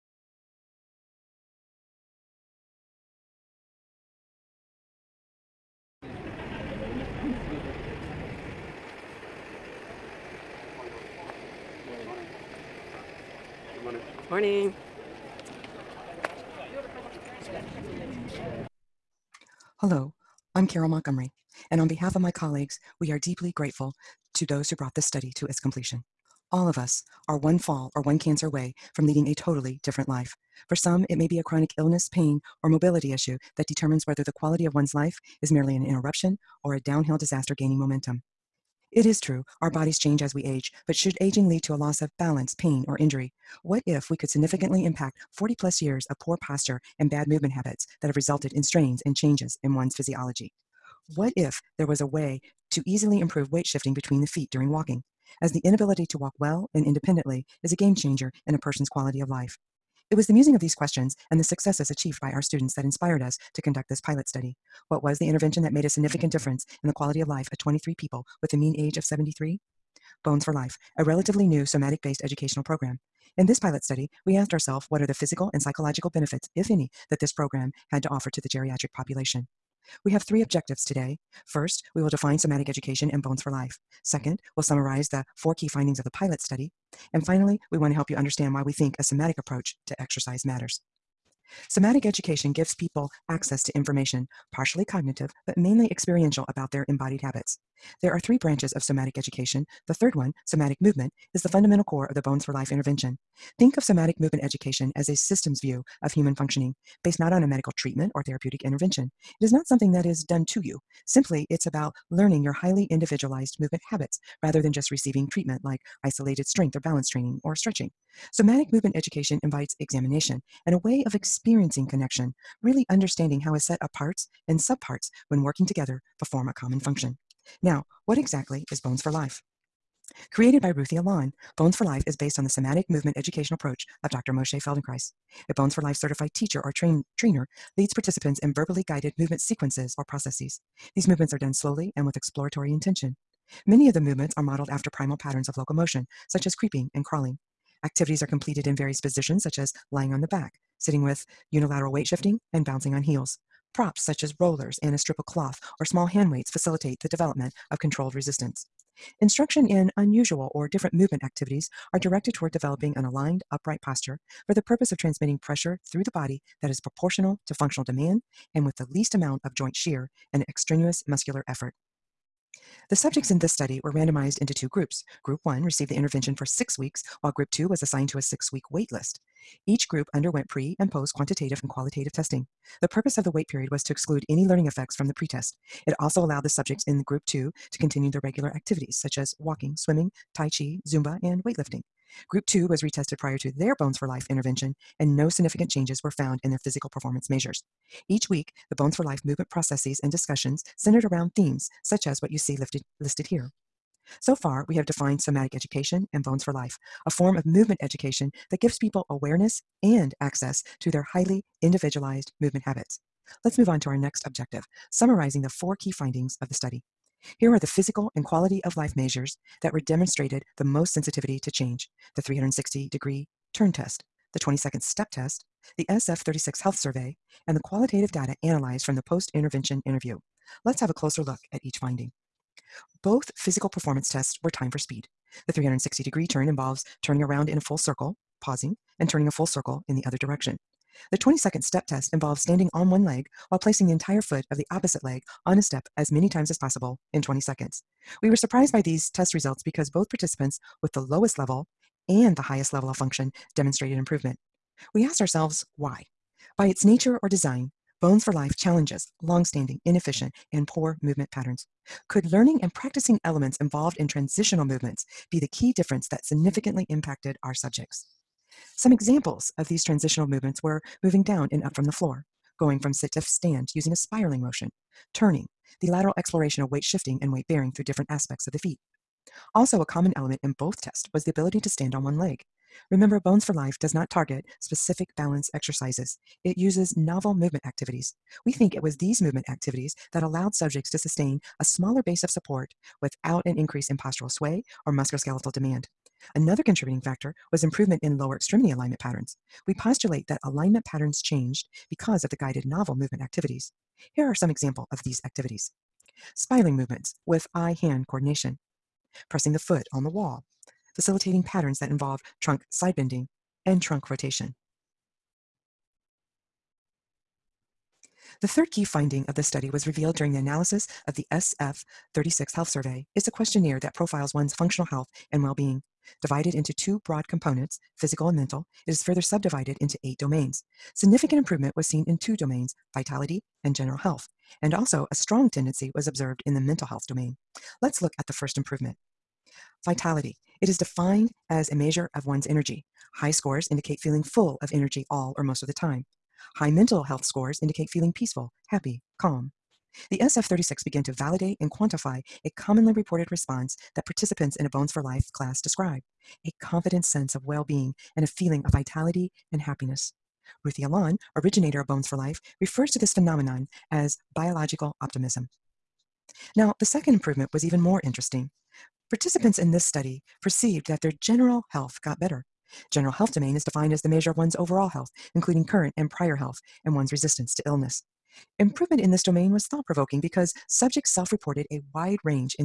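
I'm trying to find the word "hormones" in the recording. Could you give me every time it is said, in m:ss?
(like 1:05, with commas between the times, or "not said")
not said.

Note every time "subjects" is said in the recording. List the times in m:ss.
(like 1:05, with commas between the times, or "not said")
2:52, 3:06, 4:27, 4:50, 6:20.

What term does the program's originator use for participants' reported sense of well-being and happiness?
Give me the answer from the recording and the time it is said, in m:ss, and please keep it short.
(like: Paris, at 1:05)
biological optimism, at 6:04.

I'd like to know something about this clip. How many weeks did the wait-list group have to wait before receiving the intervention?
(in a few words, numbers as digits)
6.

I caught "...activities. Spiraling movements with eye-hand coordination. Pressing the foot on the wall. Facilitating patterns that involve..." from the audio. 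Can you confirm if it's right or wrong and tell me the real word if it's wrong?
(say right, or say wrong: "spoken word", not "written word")
right.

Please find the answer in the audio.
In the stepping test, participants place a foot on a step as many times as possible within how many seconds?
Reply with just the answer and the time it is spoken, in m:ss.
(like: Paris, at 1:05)
20, at 4:07.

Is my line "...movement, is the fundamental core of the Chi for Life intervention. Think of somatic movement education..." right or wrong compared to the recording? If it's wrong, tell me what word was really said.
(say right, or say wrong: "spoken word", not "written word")
wrong: "Bones", not "Chi".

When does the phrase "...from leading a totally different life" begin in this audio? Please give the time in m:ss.
0:28.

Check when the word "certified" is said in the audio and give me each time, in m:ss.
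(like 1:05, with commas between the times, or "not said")
2:15.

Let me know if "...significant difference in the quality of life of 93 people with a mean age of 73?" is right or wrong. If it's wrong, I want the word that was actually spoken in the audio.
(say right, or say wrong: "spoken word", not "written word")
wrong: "23", not "93".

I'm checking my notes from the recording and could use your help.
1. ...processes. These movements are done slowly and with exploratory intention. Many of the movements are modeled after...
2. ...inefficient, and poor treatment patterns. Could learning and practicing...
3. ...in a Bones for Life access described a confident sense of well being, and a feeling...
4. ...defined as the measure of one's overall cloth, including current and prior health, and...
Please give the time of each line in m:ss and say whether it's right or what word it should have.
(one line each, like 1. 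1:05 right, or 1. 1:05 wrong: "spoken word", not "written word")
1. 2:20 right
2. 4:19 wrong: "movement", not "treatment"
3. 5:54 wrong: "class", not "access"
4. 6:13 wrong: "health", not "cloth".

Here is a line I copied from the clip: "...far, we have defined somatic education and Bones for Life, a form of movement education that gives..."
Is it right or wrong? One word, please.
right.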